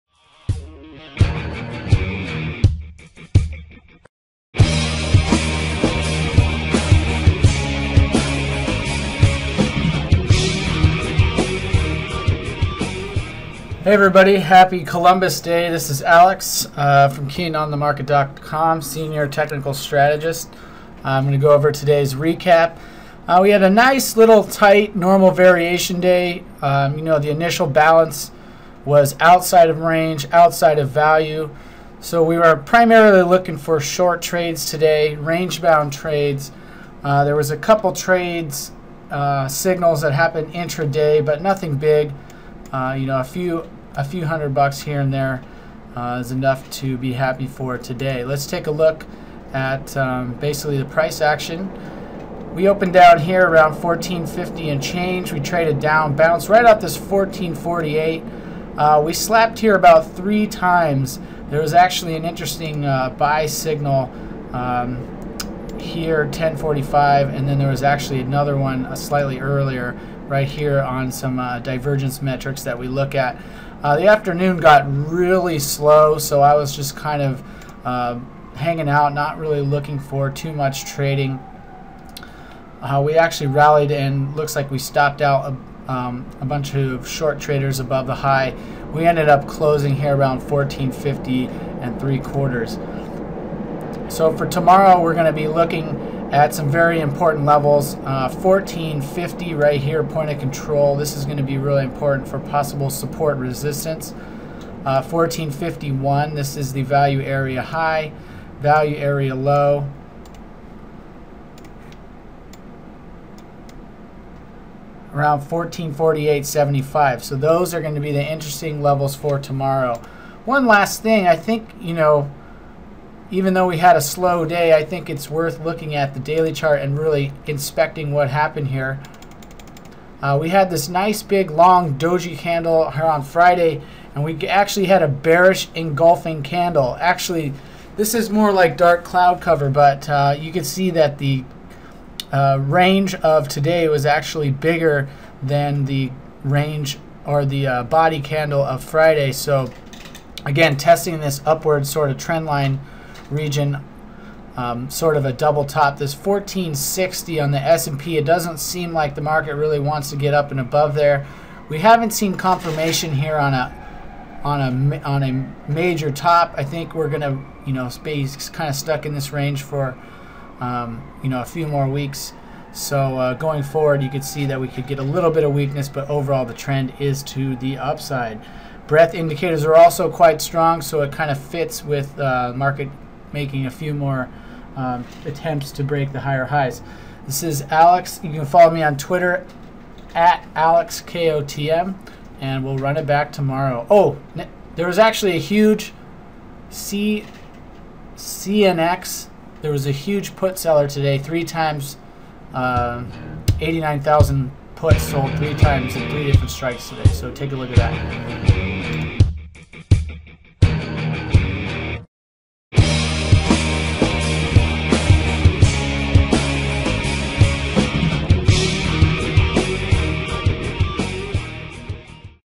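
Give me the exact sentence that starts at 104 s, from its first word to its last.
Uh, 1451, this is the value area high, value area low.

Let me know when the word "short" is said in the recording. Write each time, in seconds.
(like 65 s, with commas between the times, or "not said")
33 s, 87 s.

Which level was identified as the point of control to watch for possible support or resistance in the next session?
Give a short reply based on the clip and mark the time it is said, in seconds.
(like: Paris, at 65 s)
1450, at 98 s.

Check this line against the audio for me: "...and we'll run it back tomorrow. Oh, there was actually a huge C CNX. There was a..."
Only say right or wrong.
right.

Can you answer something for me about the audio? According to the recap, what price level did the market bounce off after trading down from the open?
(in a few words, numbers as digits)
1448.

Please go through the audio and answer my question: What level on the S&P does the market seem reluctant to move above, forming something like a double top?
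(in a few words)
1460.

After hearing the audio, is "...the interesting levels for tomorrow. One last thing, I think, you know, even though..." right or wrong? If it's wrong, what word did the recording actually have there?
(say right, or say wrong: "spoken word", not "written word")
right.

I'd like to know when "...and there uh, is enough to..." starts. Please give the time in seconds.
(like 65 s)
45 s.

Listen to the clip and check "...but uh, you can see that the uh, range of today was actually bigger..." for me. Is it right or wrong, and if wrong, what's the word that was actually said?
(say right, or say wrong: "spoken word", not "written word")
right.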